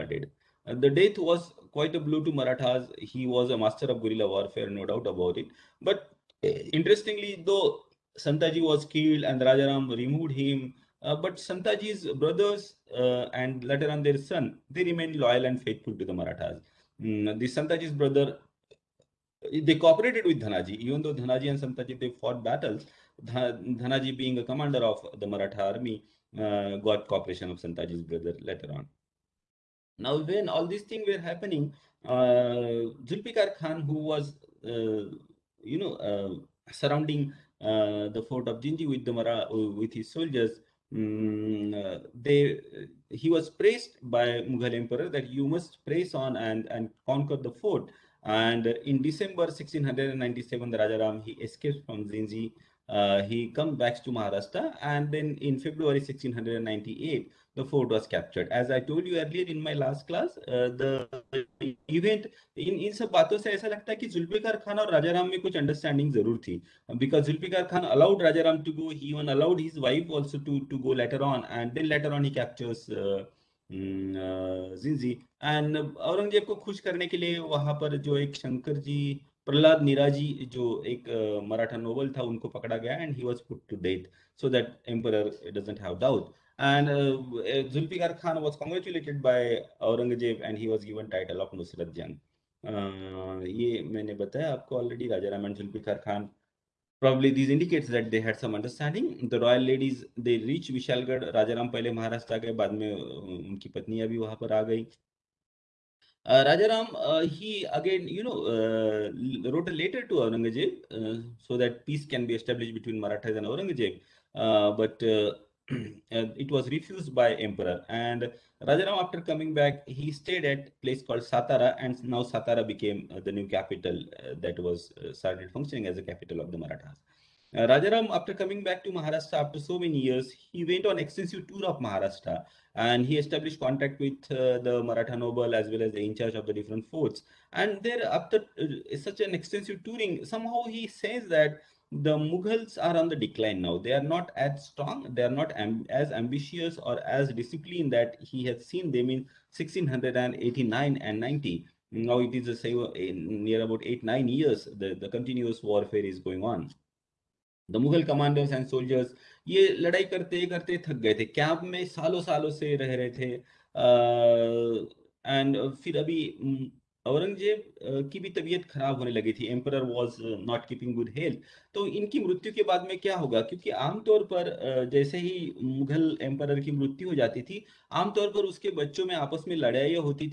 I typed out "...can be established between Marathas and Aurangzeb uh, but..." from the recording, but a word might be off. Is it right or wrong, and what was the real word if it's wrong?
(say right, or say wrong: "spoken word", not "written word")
right.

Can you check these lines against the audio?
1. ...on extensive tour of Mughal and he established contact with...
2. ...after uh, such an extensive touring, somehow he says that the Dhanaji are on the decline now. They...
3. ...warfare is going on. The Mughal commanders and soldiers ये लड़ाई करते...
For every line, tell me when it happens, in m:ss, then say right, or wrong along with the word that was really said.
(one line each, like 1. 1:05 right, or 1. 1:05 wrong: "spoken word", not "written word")
1. 2:10 wrong: "Maharashtra", not "Mughal"
2. 2:18 wrong: "Mughals", not "Dhanaji"
3. 2:35 right.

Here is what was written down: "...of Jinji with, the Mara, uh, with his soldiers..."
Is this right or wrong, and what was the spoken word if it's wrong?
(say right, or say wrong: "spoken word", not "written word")
right.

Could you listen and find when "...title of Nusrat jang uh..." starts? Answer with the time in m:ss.
1:31.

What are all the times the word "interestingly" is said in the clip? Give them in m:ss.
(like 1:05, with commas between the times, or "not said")
0:06.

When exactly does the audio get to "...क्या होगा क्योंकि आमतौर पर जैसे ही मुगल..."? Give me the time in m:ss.
2:53.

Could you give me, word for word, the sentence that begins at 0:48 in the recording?
And in December 1697, the Rajaram, he escapes from Jinji.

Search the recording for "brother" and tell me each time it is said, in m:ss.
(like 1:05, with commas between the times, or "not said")
0:12, 0:17, 0:28.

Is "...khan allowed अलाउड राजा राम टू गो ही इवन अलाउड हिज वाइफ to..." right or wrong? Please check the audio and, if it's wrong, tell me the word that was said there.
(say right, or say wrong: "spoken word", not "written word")
right.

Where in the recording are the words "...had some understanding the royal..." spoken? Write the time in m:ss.
1:38.